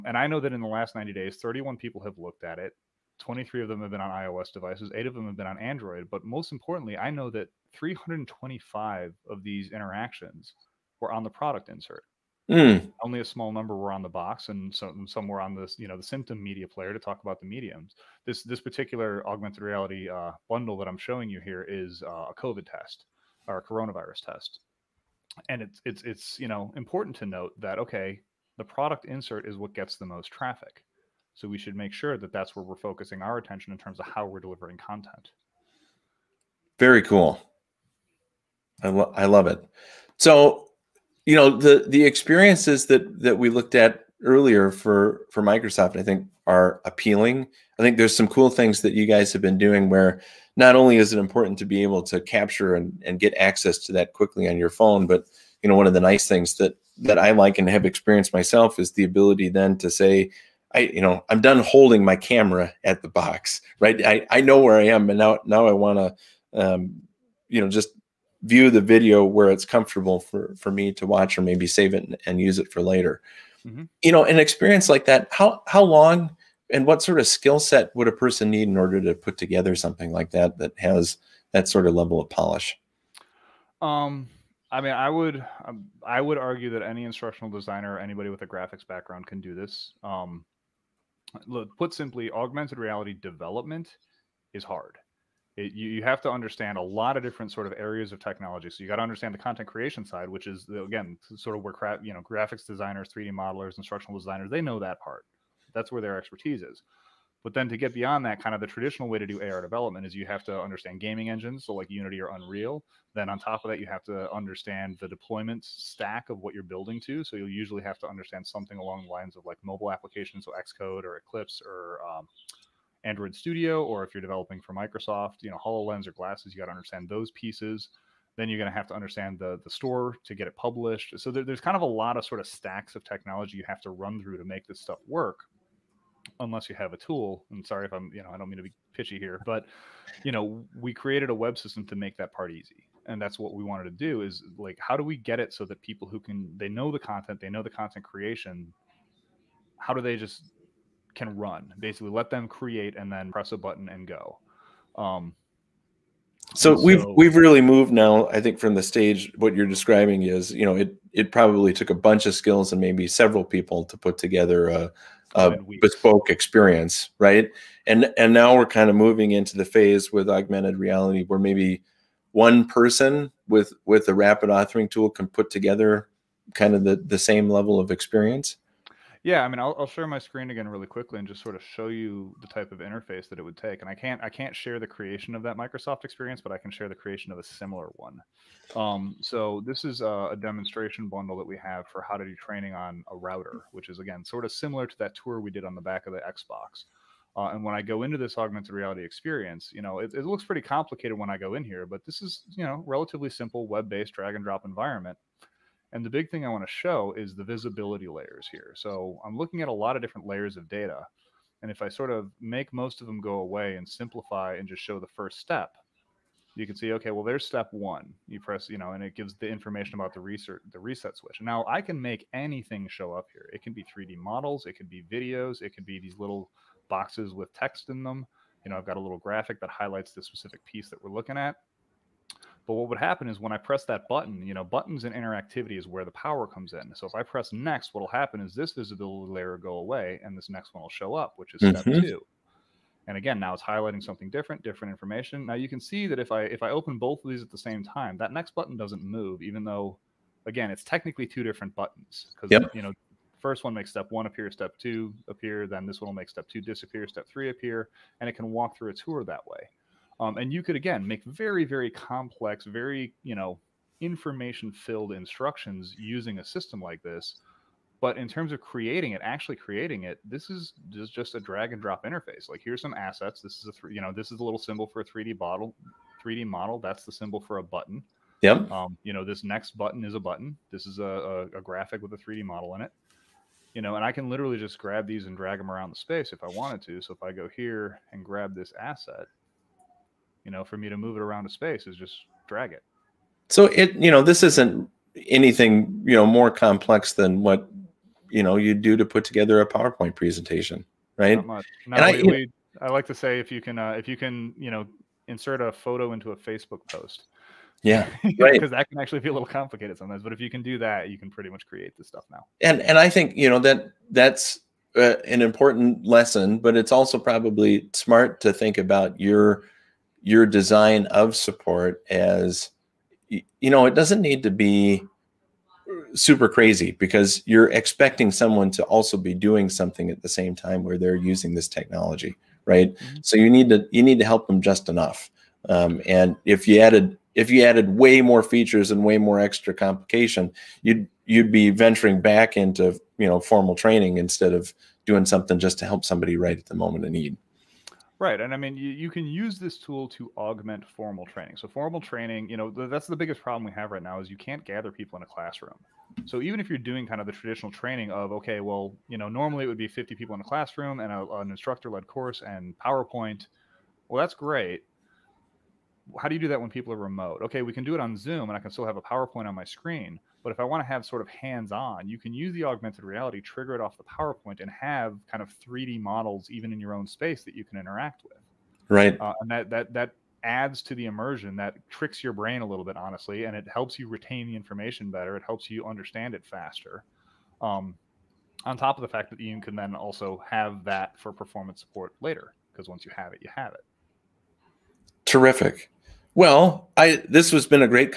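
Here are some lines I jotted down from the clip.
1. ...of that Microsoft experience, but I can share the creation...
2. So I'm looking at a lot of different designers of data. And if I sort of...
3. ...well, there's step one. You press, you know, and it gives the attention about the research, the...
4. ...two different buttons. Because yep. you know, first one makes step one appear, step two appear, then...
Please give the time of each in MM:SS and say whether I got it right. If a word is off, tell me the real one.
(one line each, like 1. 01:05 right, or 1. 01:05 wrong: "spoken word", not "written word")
1. 03:05 right
2. 03:28 wrong: "layers", not "designers"
3. 03:37 wrong: "information", not "attention"
4. 04:11 right.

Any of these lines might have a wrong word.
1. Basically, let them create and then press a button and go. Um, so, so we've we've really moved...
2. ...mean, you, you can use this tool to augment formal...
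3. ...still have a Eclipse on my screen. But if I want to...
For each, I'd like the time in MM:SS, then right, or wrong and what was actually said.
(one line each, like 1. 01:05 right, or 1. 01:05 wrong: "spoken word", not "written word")
1. 02:31 right
2. 05:48 right
3. 06:08 wrong: "PowerPoint", not "Eclipse".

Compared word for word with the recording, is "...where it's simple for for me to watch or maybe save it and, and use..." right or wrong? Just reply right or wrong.
wrong.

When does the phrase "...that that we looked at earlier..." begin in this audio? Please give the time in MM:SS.
00:42.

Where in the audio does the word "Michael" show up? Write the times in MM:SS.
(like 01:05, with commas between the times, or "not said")
not said.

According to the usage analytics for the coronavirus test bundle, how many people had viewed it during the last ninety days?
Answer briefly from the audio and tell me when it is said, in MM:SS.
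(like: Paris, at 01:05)
31, at 00:01.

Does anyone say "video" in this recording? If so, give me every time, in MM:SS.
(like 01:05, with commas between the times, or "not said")
01:08, 03:45.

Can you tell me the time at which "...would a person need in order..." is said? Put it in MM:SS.
01:17.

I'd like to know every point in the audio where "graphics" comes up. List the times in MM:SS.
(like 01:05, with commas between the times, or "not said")
01:28, 01:42, 03:49, 04:41.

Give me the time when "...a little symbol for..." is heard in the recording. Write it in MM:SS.
04:34.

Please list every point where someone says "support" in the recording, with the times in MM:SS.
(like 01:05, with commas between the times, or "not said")
05:21, 06:31.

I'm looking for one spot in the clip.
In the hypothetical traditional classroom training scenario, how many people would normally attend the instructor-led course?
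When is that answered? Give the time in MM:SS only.
05:59.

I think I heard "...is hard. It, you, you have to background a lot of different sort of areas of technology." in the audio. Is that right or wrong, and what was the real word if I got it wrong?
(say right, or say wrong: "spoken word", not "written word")
wrong: "understand", not "background".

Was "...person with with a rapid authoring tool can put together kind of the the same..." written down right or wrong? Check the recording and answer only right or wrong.
right.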